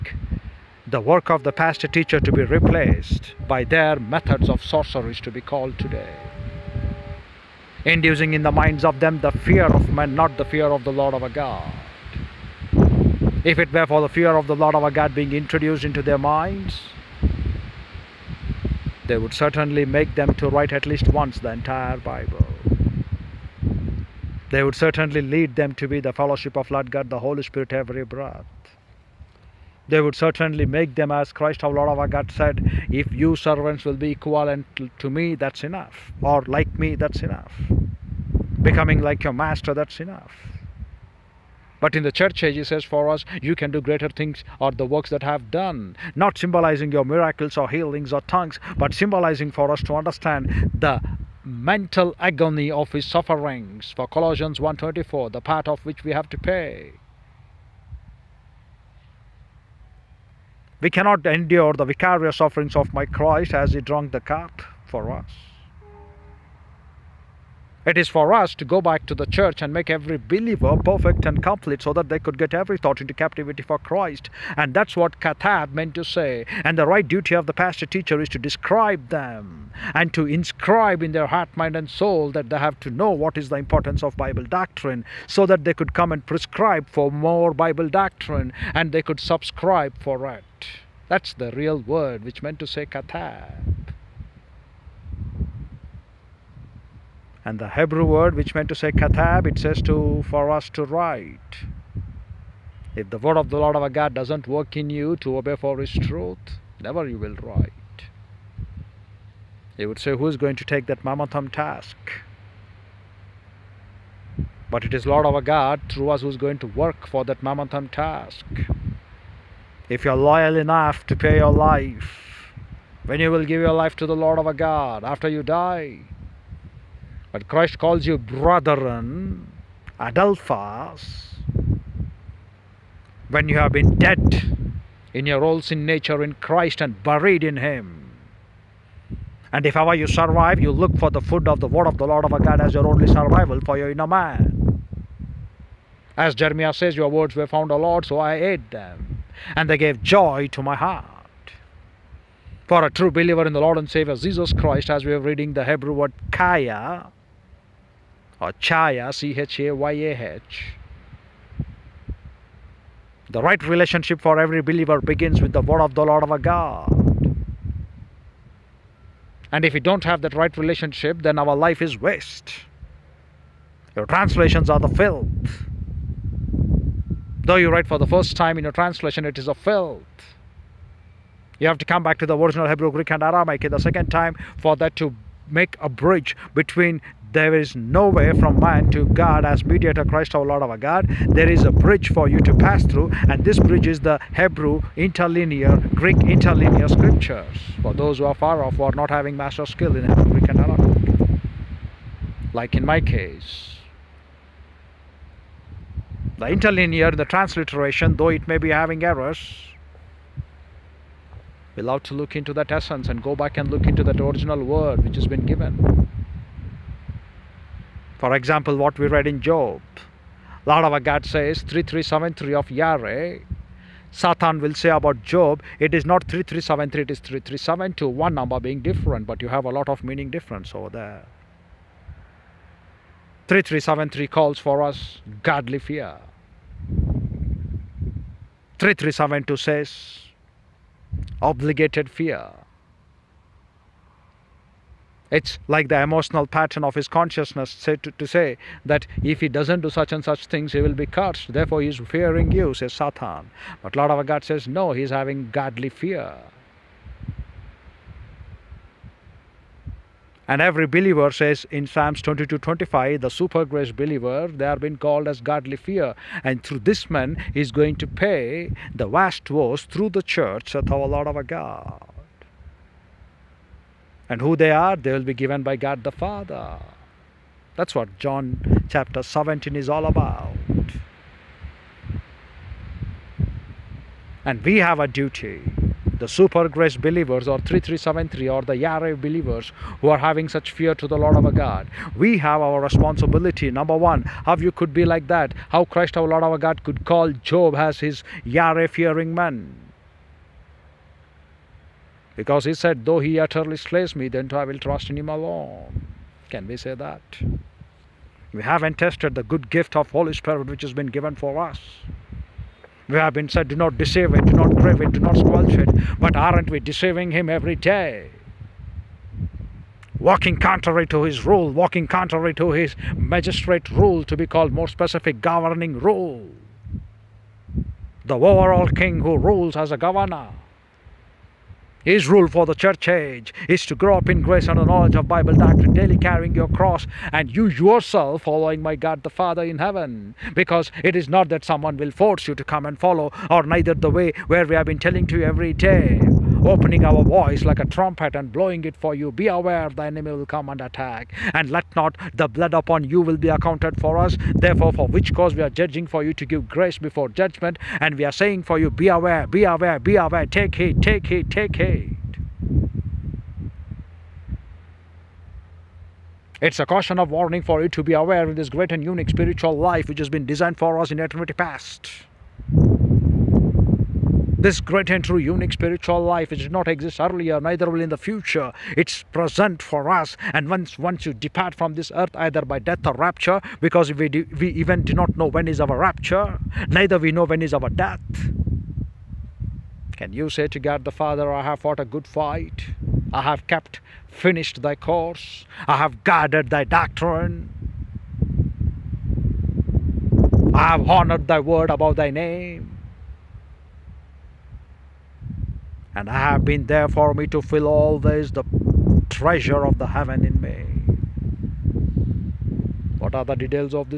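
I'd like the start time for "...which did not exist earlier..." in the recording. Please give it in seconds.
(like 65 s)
376 s.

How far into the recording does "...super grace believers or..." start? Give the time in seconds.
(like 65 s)
286 s.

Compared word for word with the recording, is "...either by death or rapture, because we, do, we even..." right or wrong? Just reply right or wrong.
right.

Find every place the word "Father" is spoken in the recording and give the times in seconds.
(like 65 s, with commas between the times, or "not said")
276 s, 339 s, 391 s.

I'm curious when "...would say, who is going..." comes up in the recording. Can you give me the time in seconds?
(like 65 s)
109 s.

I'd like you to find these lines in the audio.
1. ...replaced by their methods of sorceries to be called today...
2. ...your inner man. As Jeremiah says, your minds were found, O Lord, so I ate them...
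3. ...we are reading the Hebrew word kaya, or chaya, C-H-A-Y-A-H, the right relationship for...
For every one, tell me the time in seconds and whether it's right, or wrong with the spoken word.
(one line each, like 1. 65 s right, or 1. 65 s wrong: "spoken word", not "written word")
1. 2 s right
2. 143 s wrong: "words", not "minds"
3. 155 s right.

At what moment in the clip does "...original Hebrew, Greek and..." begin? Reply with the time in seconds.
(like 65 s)
182 s.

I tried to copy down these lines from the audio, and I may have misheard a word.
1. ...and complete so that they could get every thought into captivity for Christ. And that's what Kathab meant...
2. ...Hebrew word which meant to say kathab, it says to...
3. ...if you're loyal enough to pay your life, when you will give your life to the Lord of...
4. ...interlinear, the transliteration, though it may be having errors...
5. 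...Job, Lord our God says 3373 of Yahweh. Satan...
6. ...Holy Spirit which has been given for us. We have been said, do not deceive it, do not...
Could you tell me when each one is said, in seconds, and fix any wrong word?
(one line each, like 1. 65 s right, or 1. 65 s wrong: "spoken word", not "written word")
1. 71 s right
2. 97 s right
3. 119 s right
4. 206 s right
5. 219 s right
6. 310 s right.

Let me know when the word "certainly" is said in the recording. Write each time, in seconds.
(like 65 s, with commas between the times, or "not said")
19 s, 24 s, 30 s.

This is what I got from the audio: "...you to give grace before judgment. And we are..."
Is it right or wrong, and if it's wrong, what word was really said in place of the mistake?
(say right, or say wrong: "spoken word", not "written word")
right.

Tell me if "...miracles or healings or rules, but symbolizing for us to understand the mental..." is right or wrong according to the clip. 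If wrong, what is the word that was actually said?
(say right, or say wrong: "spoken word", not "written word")
wrong: "tongues", not "rules".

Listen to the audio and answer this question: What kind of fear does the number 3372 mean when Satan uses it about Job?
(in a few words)
obligated fear.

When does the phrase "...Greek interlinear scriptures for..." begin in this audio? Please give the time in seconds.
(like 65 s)
195 s.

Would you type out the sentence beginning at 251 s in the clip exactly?
Therefore, he's fearing you, says Satan.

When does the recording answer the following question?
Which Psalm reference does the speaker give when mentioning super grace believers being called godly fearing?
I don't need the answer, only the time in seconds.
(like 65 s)
261 s.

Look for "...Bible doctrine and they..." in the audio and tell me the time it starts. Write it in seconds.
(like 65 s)
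87 s.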